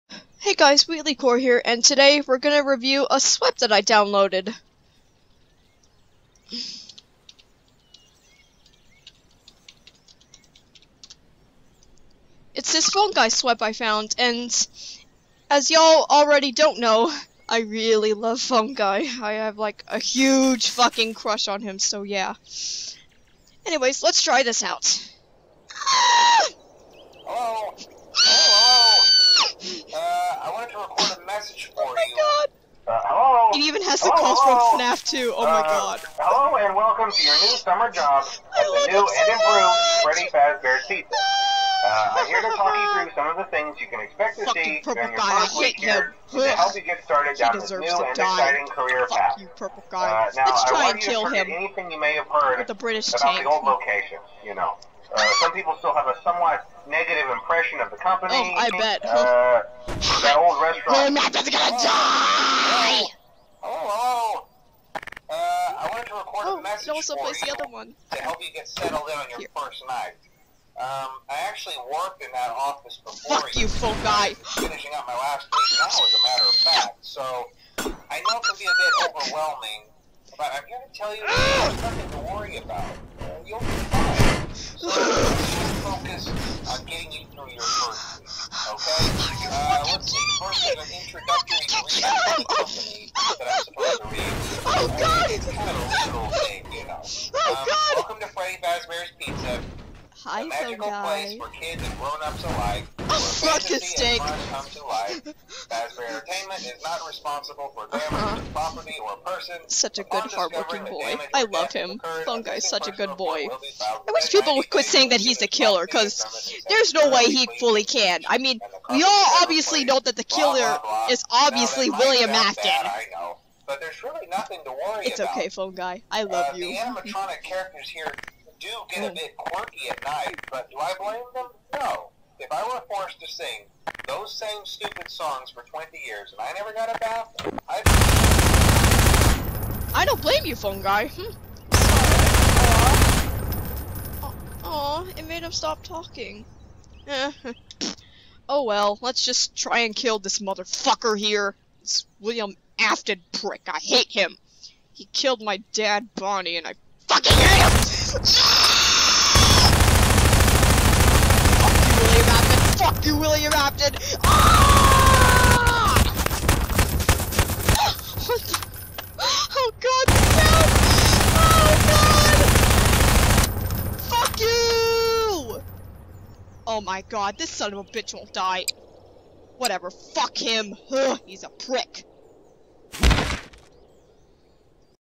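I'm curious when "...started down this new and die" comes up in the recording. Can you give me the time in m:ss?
0:47.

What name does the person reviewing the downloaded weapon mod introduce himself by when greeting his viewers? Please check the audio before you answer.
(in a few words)
WheatleyCore.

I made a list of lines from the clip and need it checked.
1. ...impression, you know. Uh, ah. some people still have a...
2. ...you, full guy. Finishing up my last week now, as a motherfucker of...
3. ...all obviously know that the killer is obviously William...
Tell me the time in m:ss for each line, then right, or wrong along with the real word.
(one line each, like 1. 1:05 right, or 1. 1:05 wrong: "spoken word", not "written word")
1. 0:53 wrong: "location", not "impression"
2. 1:13 wrong: "matter", not "motherfucker"
3. 1:59 right.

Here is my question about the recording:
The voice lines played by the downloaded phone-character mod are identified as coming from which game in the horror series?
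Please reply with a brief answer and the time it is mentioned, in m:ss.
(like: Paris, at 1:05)
FNAF 2, at 0:34.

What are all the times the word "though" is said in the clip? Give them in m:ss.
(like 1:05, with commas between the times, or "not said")
not said.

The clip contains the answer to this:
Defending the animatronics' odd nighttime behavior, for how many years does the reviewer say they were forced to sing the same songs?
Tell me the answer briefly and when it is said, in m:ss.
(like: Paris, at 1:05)
20, at 2:15.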